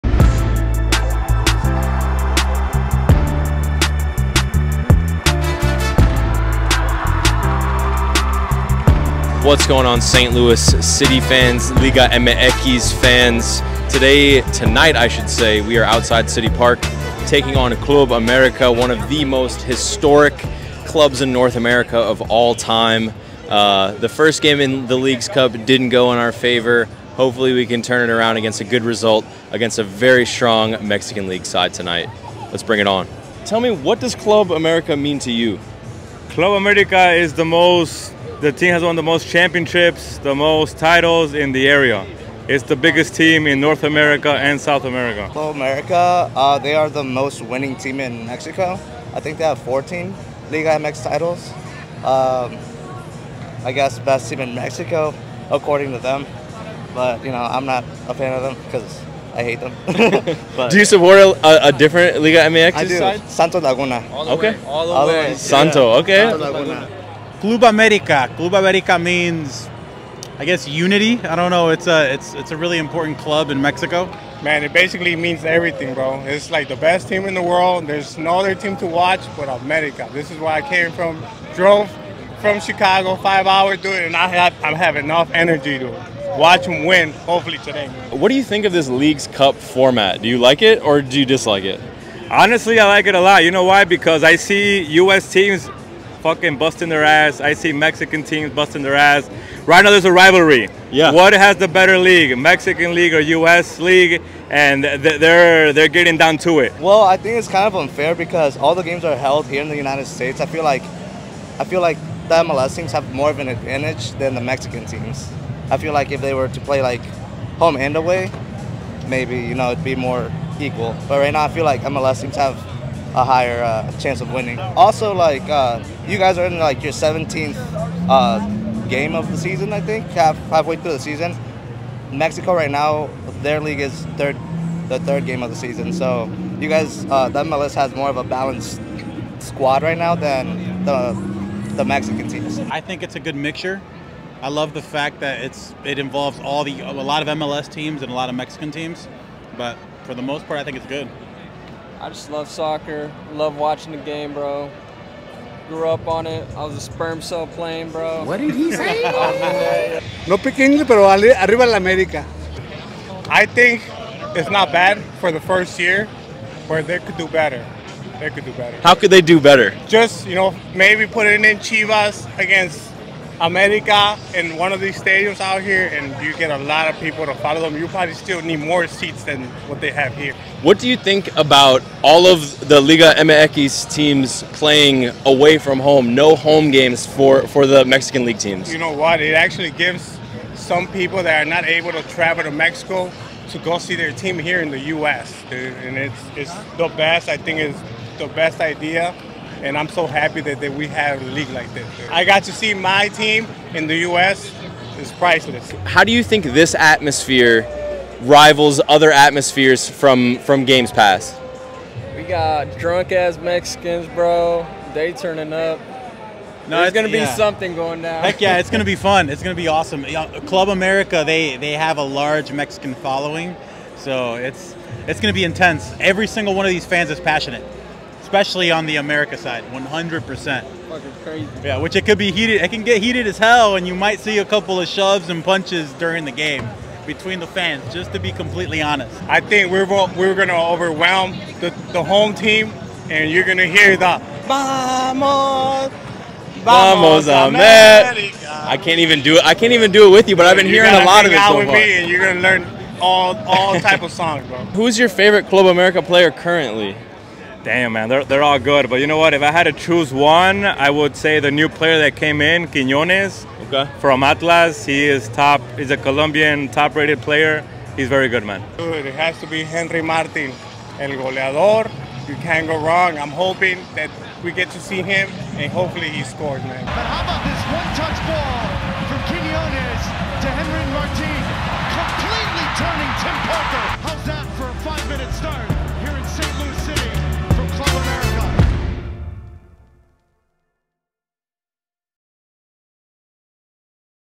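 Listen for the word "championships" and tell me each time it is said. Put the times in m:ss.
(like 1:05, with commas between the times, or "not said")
0:39.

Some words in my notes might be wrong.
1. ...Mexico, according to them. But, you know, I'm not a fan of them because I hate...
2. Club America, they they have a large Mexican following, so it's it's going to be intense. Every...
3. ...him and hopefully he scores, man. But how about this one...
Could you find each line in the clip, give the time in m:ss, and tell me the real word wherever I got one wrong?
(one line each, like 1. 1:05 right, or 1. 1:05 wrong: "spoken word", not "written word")
1. 0:54 right
2. 3:40 right
3. 4:35 right.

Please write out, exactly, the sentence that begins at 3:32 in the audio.
We got drunk ass Mexicans, bro.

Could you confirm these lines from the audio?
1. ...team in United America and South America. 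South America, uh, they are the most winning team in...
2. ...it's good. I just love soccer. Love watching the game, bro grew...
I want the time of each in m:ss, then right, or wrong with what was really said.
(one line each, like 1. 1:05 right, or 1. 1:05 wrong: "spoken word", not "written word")
1. 0:43 wrong: "North", not "United"
2. 2:30 right.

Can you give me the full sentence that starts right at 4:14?
Who's your favorite Club America player currently?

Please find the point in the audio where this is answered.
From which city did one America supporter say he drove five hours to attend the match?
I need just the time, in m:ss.
1:22.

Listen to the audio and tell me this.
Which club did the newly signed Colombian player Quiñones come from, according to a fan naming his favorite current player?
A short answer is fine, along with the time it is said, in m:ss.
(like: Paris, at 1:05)
Atlas, at 4:24.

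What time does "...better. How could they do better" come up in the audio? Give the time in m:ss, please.
2:48.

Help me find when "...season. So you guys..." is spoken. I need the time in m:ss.
2:15.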